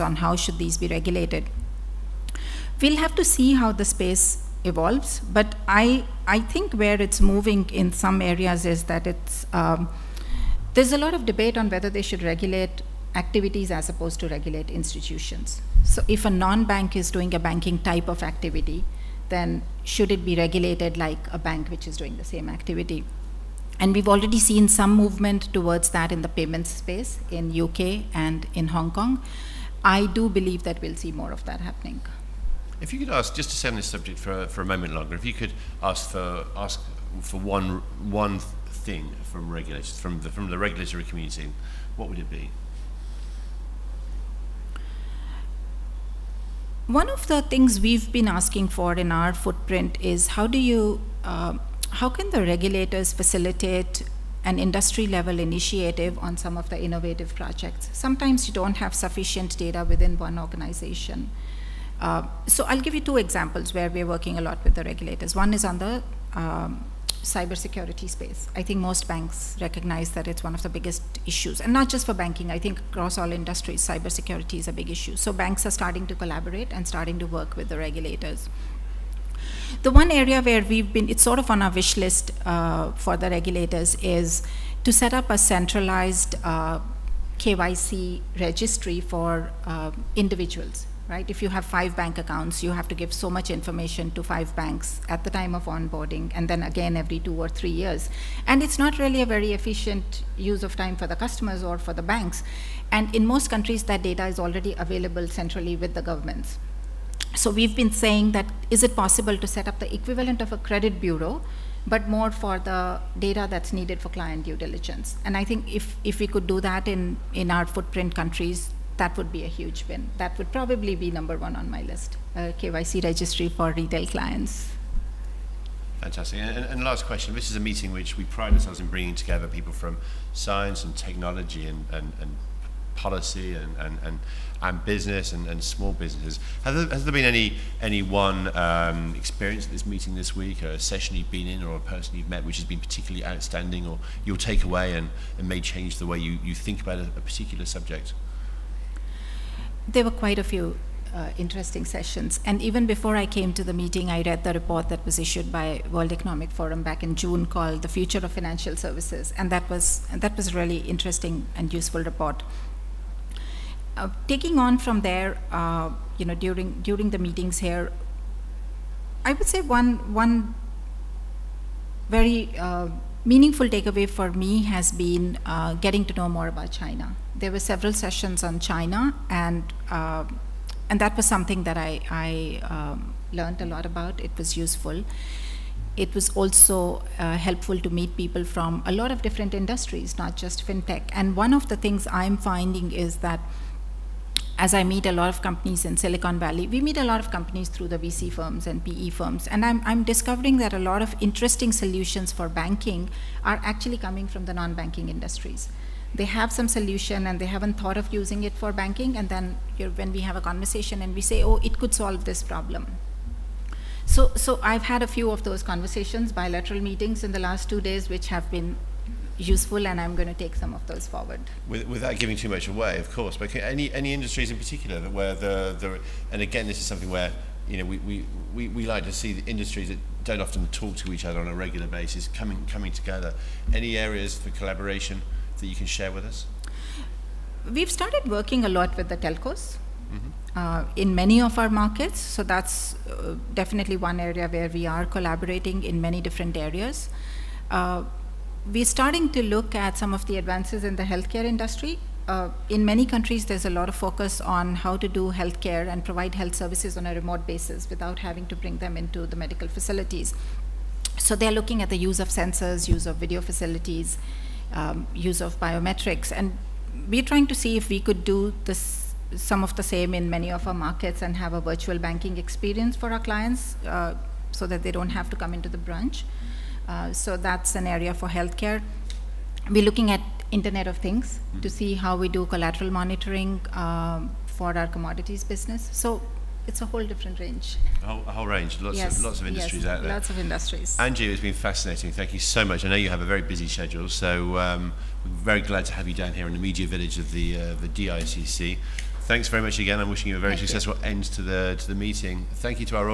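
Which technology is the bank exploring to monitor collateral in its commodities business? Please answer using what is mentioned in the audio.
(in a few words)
Internet of Things.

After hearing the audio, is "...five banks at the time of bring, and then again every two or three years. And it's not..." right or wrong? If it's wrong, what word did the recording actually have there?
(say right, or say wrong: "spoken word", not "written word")
wrong: "onboarding", not "bring".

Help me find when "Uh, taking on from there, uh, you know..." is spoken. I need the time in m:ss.
2:43.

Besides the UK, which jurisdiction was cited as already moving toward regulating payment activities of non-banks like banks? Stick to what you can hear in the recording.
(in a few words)
Hong Kong.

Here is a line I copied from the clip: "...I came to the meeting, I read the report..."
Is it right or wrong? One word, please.
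right.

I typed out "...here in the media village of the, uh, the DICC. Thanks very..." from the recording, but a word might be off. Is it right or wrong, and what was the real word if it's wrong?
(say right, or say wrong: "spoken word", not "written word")
right.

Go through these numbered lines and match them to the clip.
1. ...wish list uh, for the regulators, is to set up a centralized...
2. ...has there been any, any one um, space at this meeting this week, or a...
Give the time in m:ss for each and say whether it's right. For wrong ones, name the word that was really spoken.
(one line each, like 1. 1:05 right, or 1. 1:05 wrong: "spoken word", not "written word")
1. 1:21 right
2. 2:16 wrong: "experience", not "space".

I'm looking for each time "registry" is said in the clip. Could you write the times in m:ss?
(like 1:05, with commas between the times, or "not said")
1:28, 2:03.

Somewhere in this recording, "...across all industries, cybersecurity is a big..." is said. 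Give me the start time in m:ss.
1:12.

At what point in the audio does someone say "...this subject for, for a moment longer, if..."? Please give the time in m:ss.
0:33.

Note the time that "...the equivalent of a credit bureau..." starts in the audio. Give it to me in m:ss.
1:49.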